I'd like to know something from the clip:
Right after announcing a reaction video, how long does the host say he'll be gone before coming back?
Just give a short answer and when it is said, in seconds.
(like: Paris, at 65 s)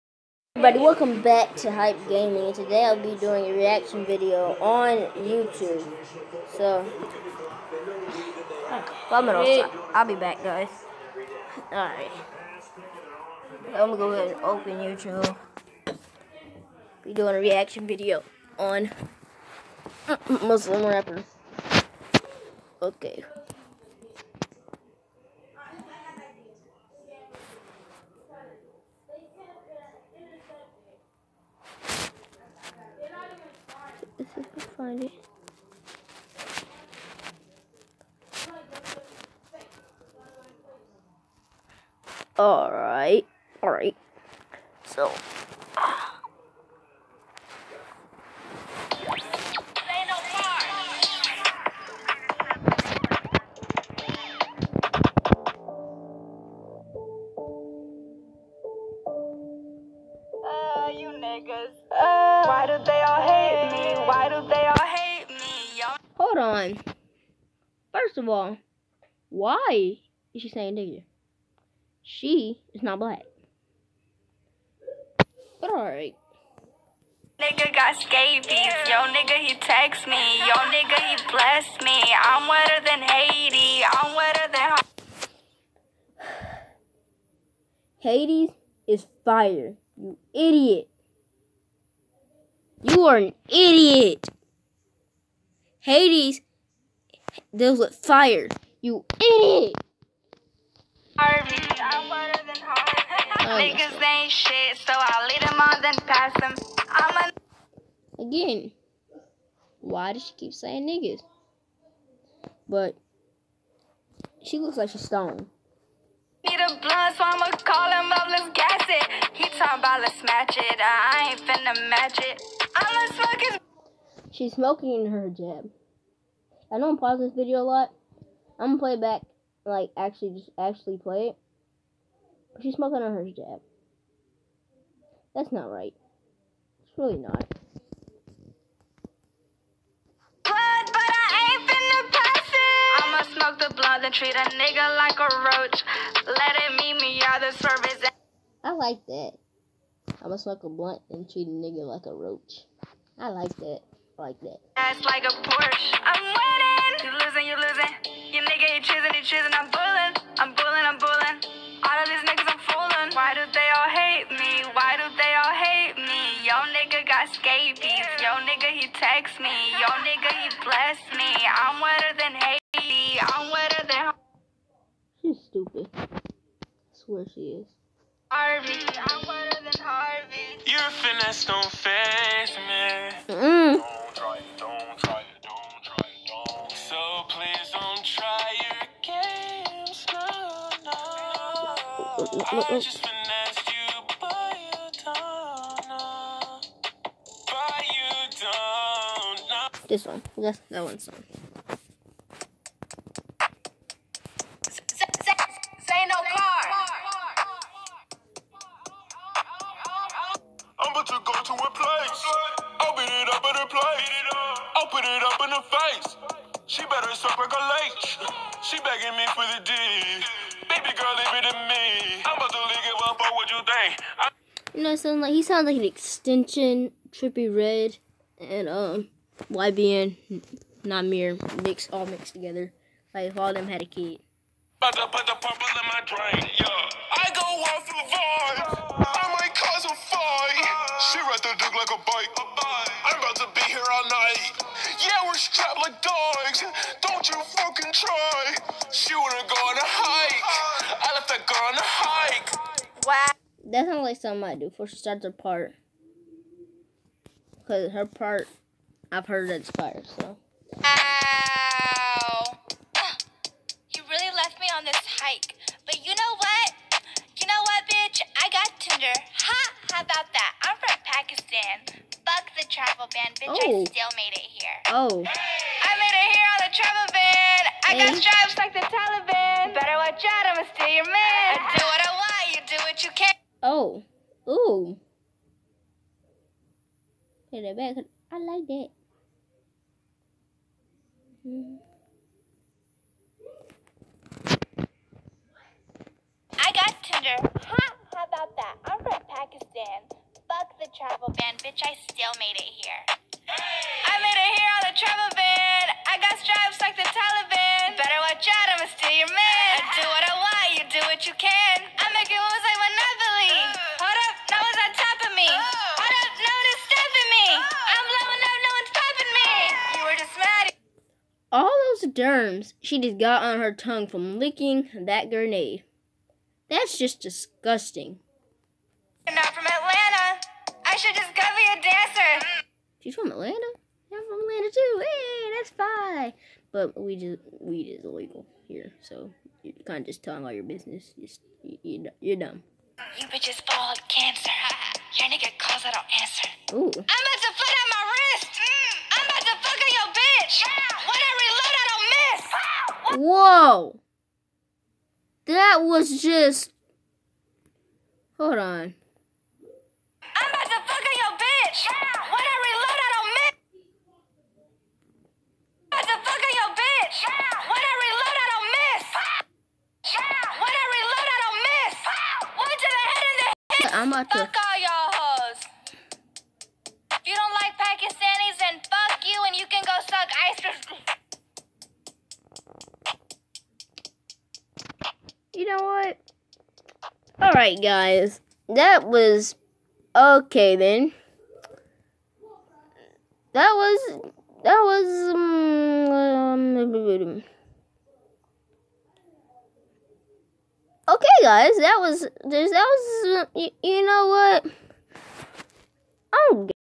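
5 minutes, at 9 s.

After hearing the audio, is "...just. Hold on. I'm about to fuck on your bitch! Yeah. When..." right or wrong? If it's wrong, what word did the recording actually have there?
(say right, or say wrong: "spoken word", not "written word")
right.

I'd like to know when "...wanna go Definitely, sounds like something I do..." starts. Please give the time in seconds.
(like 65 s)
249 s.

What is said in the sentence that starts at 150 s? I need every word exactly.
I'ma smoke a blunt and treat a nigga like a roach.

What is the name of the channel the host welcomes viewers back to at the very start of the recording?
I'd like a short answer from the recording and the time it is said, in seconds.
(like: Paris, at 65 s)
Hype Gaming, at 1 s.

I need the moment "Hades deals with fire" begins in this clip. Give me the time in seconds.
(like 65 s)
95 s.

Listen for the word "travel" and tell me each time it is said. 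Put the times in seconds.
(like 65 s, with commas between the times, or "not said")
272 s, 276 s, 300 s, 304 s.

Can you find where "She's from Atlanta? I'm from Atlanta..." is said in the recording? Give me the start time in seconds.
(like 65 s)
332 s.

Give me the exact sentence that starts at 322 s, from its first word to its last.
derms she just got on her tongue from licking that grenade.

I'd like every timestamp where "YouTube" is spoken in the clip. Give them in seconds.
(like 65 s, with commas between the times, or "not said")
5 s, 14 s.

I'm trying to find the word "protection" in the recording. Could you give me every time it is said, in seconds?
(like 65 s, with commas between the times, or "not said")
not said.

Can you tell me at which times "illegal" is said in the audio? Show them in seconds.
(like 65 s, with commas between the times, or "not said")
338 s.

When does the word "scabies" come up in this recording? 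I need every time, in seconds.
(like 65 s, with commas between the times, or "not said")
77 s, 167 s.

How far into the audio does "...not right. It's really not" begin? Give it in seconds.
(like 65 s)
135 s.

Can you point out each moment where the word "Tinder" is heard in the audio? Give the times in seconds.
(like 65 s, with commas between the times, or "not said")
268 s, 297 s.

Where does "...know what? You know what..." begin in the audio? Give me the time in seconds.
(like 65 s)
266 s.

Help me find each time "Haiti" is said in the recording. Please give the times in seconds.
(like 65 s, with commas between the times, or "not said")
83 s, 172 s.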